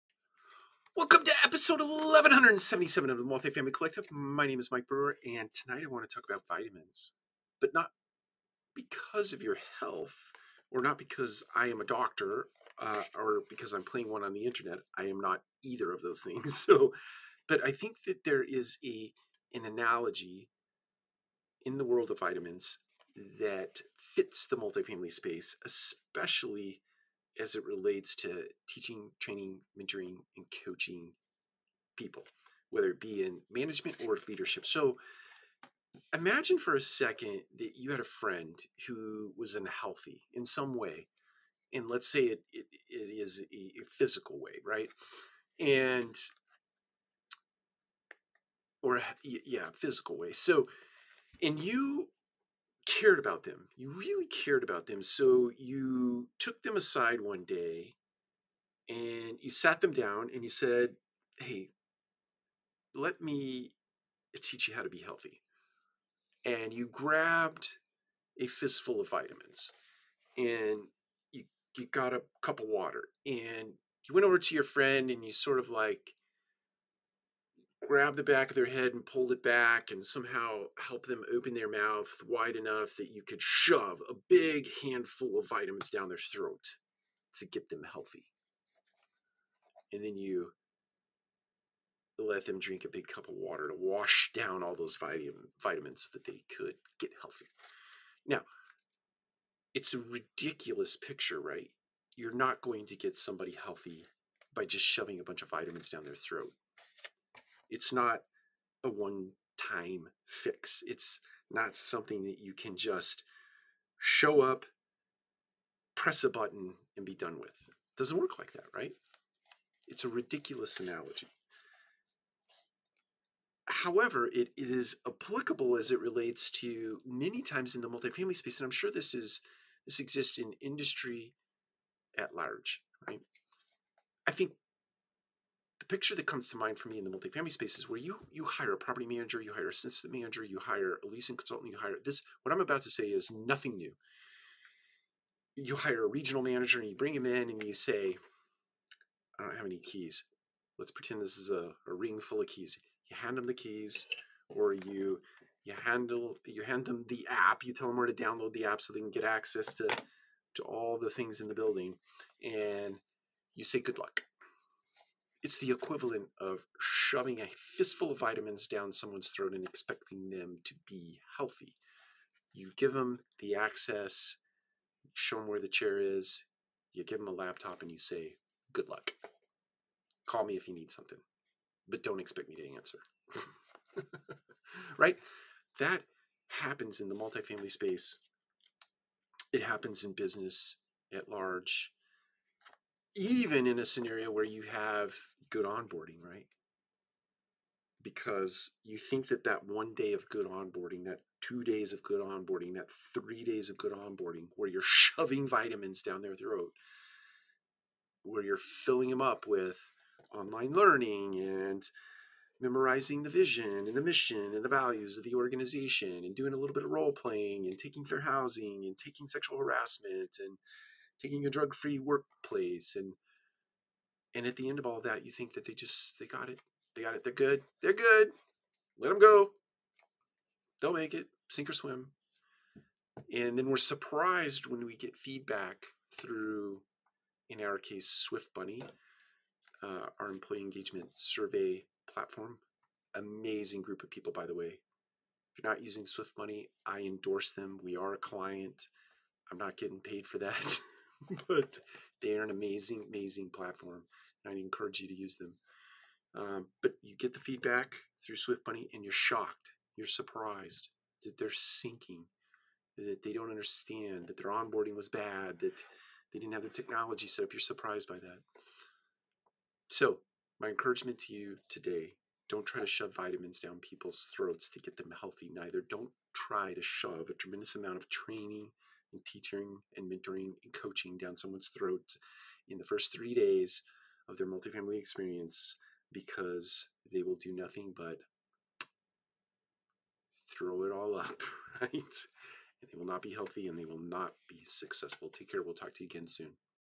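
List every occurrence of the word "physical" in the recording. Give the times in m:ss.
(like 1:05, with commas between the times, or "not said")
0:43, 0:49.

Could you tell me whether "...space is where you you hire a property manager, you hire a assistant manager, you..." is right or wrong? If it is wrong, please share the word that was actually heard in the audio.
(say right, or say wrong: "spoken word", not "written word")
right.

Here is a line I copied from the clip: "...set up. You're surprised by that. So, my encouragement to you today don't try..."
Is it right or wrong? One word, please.
right.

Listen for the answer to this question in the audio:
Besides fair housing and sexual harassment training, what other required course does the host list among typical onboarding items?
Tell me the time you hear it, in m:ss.
3:41.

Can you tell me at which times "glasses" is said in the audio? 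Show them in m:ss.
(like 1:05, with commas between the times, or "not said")
not said.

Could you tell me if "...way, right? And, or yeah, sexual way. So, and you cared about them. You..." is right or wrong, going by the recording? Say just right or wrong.
wrong.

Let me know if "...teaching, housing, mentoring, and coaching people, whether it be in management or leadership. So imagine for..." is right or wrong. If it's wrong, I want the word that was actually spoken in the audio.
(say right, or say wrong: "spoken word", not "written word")
wrong: "training", not "housing".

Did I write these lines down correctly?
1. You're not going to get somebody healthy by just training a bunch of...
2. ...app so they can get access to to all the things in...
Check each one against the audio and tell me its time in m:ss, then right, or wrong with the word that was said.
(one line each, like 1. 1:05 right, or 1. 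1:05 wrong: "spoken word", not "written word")
1. 1:42 wrong: "shoving", not "training"
2. 2:38 right.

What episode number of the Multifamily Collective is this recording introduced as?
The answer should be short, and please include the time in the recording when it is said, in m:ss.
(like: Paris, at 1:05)
1177, at 0:01.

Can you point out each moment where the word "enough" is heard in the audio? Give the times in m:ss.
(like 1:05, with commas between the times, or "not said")
1:22.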